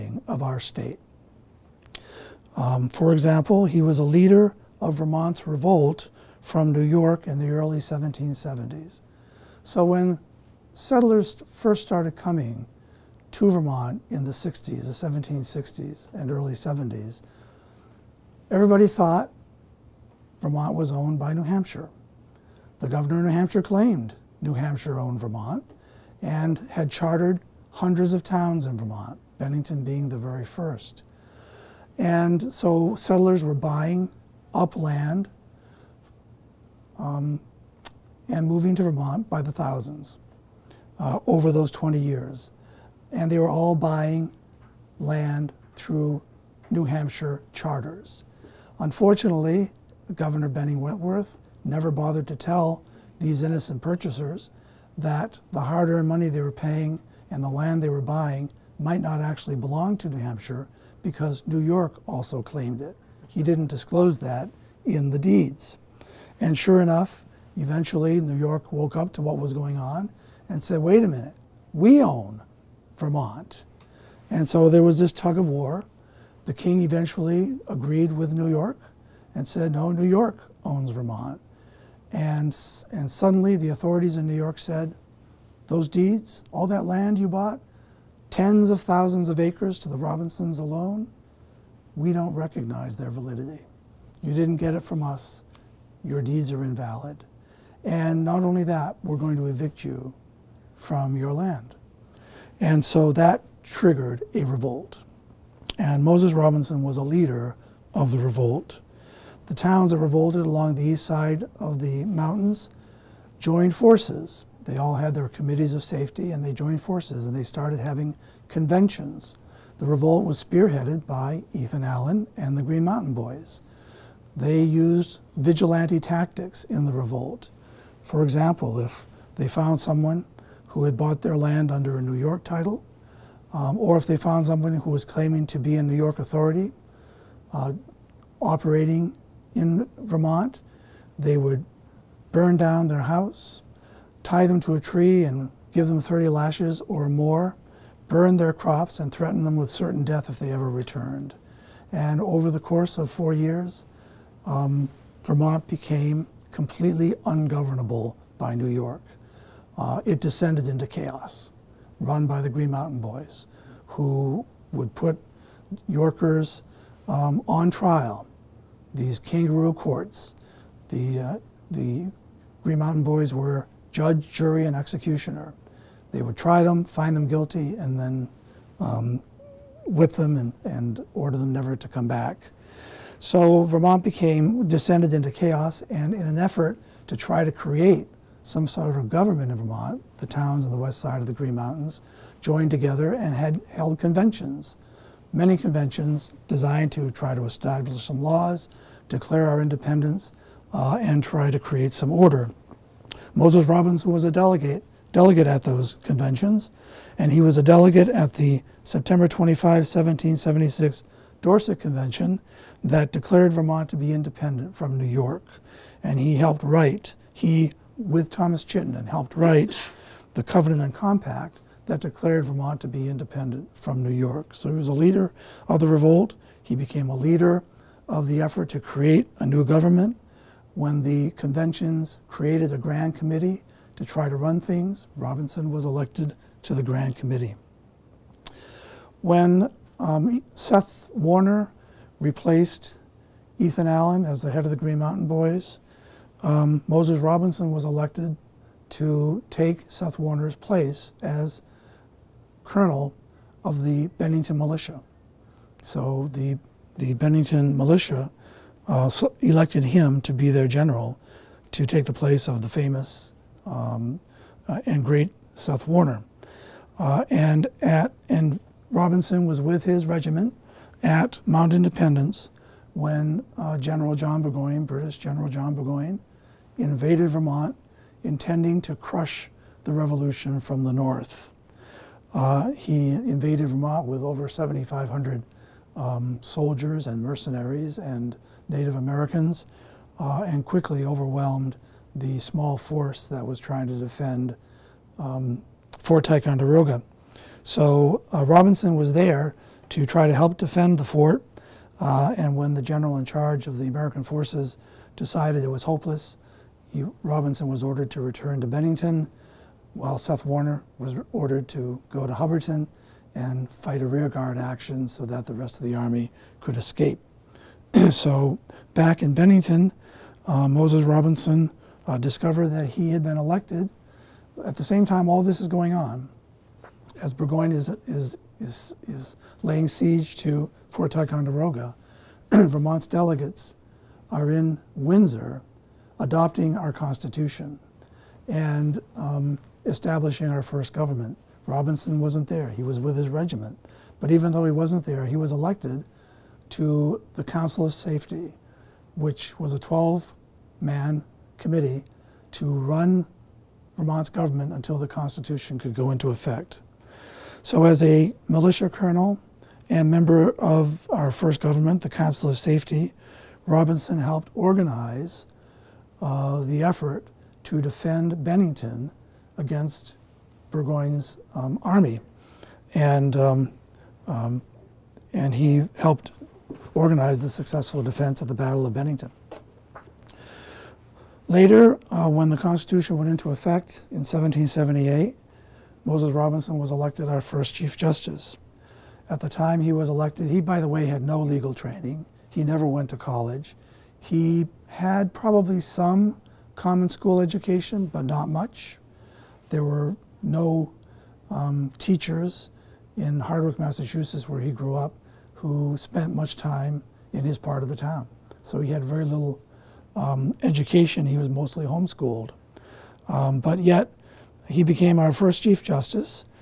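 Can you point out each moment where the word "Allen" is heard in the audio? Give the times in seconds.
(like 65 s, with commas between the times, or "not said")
121 s, 243 s.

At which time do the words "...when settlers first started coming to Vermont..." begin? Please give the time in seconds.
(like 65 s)
9 s.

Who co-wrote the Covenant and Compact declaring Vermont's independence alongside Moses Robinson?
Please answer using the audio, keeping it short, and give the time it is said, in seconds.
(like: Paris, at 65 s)
Thomas Chittenden, at 218 s.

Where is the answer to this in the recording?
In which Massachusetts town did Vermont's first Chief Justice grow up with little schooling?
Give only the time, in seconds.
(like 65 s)
403 s.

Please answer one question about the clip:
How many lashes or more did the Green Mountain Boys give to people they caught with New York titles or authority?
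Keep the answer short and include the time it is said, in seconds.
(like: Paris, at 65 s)
30, at 146 s.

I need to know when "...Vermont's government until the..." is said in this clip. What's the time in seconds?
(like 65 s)
353 s.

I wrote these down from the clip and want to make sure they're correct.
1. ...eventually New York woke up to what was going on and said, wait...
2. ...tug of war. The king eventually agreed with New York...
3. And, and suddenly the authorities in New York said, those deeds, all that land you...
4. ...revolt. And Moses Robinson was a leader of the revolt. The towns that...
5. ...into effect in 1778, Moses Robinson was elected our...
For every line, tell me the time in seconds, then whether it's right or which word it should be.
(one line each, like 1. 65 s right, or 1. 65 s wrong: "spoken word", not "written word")
1. 67 s right
2. 75 s right
3. 82 s right
4. 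104 s right
5. 383 s right.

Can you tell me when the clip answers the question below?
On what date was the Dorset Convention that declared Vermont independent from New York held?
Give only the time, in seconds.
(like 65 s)
208 s.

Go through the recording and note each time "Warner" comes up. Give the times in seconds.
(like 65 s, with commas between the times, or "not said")
241 s, 250 s, 265 s, 310 s.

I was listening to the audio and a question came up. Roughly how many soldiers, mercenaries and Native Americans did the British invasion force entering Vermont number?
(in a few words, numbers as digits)
over 7,500.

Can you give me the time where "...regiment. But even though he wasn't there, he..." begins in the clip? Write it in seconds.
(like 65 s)
343 s.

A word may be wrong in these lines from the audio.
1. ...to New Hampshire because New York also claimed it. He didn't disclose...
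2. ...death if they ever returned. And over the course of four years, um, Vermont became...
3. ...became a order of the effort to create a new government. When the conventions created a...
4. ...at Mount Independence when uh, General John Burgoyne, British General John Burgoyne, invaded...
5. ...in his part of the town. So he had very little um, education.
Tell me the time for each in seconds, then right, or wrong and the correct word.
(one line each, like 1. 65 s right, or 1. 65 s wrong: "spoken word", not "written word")
1. 59 s right
2. 150 s right
3. 226 s wrong: "leader", not "order"
4. 271 s right
5. 407 s right.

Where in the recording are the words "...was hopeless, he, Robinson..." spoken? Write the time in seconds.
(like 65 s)
305 s.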